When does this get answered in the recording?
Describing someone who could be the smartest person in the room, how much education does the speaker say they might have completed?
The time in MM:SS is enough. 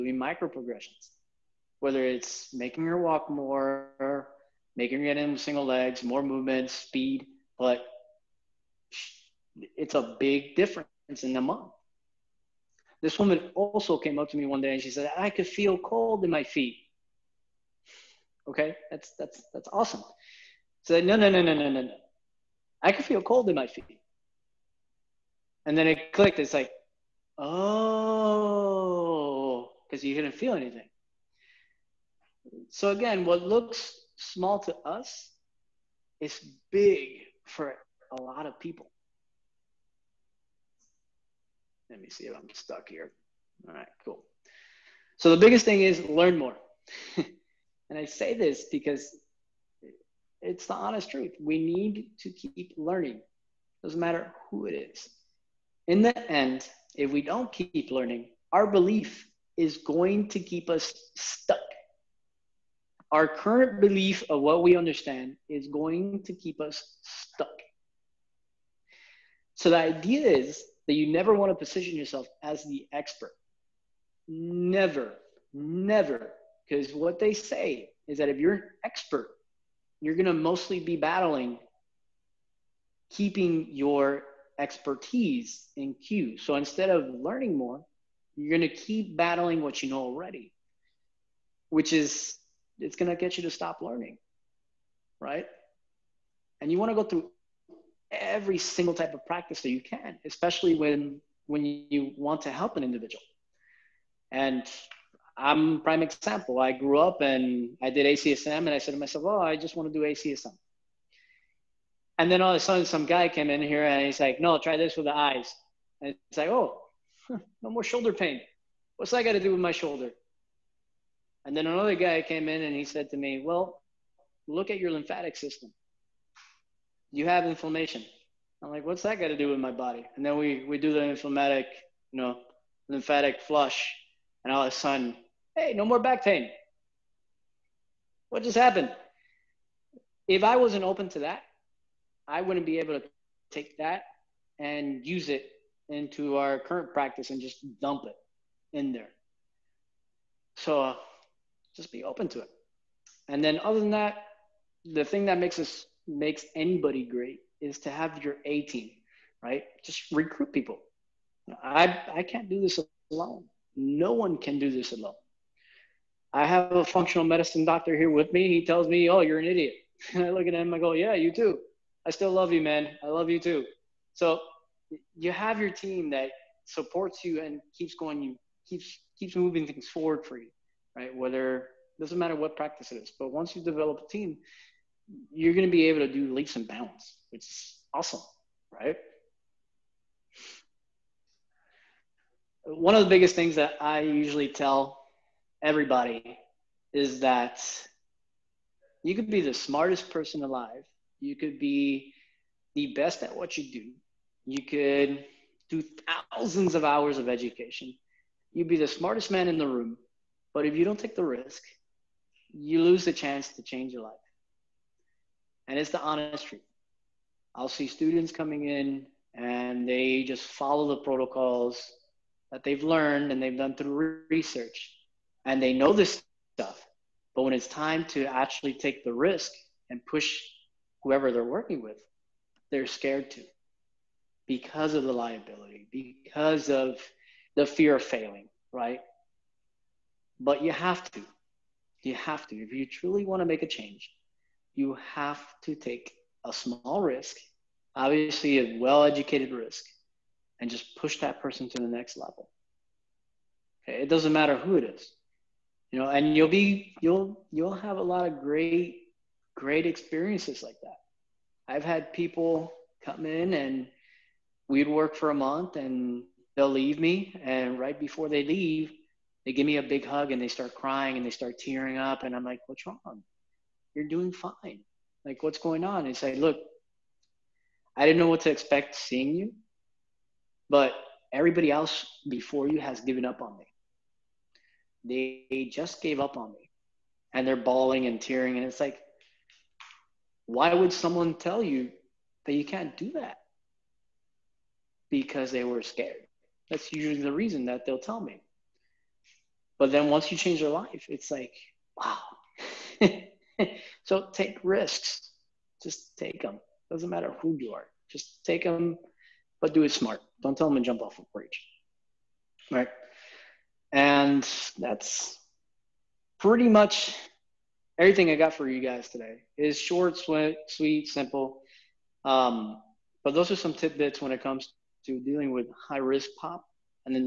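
03:26.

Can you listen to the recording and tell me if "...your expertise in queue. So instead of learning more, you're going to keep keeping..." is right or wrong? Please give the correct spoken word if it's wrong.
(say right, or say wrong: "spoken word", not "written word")
wrong: "battling", not "keeping".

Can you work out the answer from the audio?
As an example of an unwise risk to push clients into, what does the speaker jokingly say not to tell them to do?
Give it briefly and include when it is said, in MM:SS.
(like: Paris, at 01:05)
jump off a bridge, at 05:10.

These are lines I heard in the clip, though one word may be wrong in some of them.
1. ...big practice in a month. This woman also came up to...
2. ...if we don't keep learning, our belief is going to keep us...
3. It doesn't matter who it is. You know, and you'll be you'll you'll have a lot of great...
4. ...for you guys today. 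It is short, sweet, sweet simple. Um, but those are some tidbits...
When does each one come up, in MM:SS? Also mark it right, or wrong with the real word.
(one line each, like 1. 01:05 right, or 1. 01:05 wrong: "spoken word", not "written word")
1. 00:10 wrong: "difference", not "practice"
2. 00:56 right
3. 04:14 right
4. 05:18 right.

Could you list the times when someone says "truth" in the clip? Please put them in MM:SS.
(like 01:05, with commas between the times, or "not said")
00:51, 03:36.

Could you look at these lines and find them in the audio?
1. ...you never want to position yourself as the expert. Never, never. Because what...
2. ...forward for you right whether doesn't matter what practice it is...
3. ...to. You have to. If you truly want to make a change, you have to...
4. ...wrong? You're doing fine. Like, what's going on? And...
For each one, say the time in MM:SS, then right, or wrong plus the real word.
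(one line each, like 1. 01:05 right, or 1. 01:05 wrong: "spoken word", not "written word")
1. 01:10 right
2. 02:59 right
3. 04:01 right
4. 04:32 right.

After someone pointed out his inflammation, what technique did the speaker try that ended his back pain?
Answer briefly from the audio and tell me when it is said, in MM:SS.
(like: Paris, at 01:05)
lymphatic flush, at 02:12.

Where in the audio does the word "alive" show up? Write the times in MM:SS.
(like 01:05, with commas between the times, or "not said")
03:20.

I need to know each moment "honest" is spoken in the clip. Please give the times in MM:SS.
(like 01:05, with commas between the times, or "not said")
00:50, 03:36.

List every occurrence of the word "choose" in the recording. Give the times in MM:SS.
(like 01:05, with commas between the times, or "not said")
not said.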